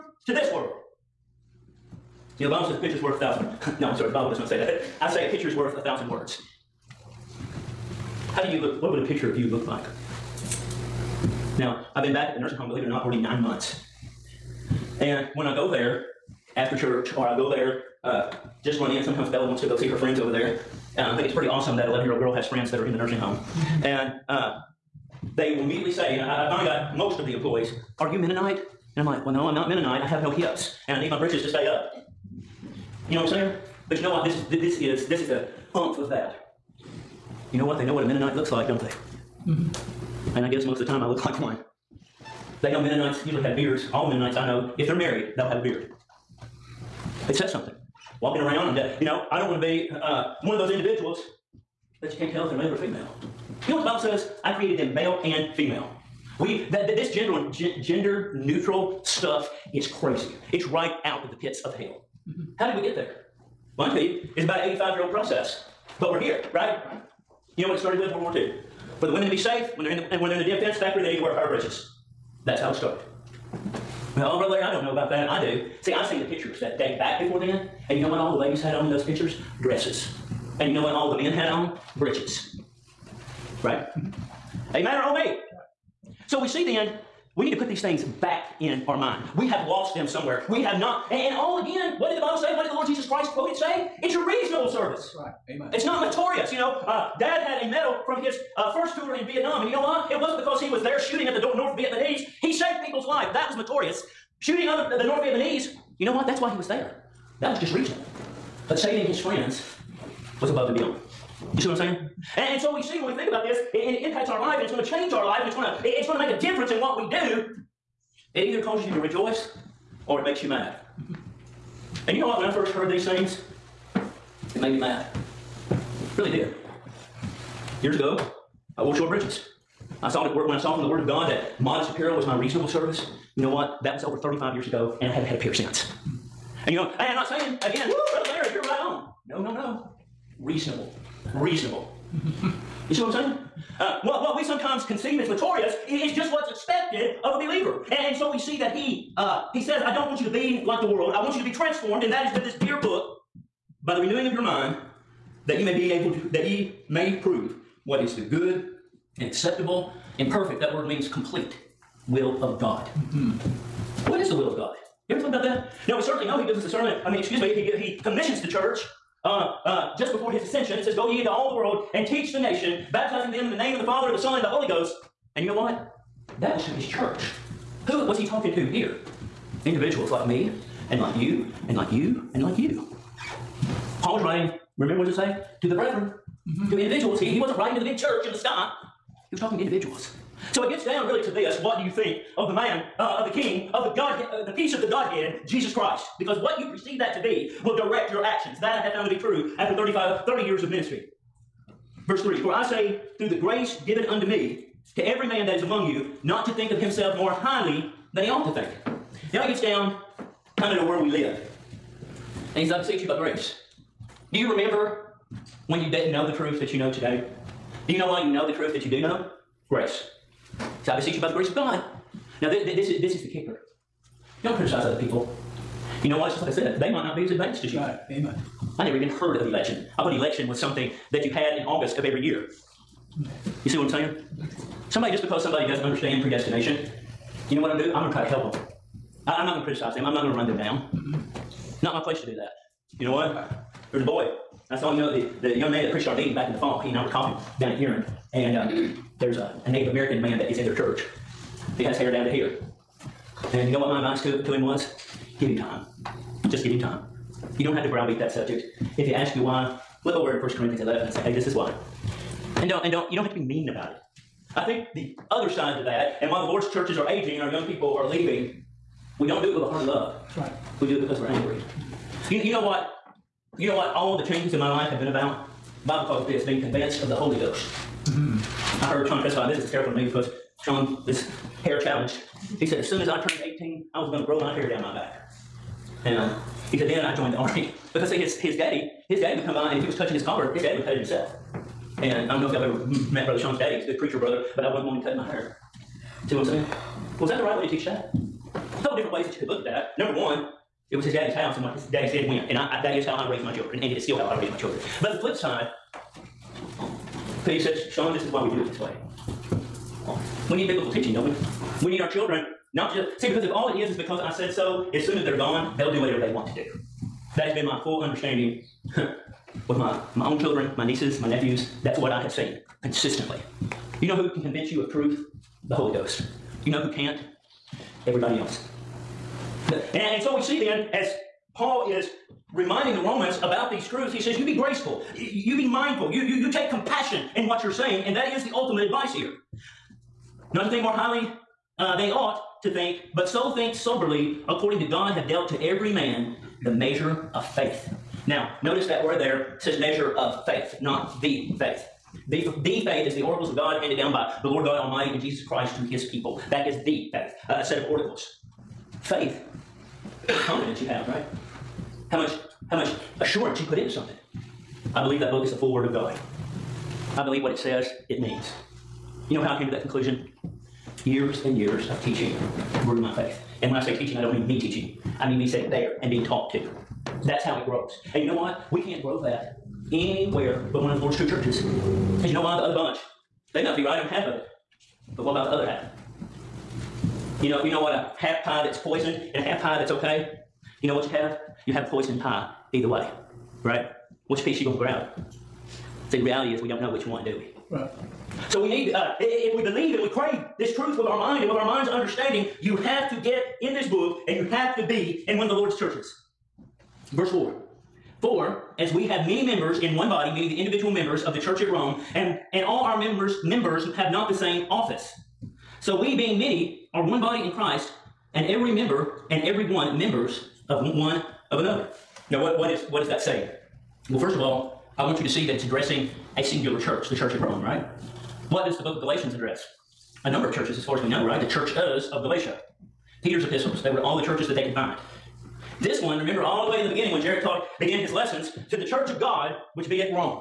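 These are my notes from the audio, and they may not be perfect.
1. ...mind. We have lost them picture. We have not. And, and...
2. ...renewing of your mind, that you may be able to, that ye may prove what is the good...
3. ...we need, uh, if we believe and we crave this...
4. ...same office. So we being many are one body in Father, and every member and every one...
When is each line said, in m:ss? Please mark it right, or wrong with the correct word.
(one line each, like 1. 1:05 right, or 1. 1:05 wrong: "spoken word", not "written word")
1. 1:28 wrong: "somewhere", not "picture"
2. 2:34 right
3. 6:38 right
4. 6:54 wrong: "Christ", not "Father".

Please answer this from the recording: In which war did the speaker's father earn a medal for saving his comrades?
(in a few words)
Vietnam.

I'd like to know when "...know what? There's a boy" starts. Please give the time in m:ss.
4:03.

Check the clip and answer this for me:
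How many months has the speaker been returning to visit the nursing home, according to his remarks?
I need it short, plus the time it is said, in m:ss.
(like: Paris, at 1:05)
9, at 0:13.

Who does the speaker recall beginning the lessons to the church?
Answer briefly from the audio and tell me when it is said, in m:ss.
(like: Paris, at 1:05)
Jared, at 7:17.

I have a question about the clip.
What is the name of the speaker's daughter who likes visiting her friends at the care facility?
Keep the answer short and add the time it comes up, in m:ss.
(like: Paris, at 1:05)
Bella, at 0:19.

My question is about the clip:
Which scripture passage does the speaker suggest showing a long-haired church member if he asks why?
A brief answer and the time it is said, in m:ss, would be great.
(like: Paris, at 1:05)
1 Corinthians 11, at 4:20.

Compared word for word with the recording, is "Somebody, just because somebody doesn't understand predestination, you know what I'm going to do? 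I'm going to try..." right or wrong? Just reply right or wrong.
right.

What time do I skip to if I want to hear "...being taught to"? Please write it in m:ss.
6:16.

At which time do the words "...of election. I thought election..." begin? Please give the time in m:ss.
3:49.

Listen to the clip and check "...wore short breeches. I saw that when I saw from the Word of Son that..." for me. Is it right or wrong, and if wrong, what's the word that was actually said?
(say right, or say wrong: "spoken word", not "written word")
wrong: "God", not "Son".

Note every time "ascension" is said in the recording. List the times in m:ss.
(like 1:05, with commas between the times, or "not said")
2:50.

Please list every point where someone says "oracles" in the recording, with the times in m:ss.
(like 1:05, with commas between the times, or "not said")
5:53, 5:57.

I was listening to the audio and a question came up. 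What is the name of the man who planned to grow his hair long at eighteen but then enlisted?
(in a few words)
Sean Prescott.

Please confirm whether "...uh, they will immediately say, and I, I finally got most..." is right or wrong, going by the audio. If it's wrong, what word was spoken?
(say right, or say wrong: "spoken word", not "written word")
right.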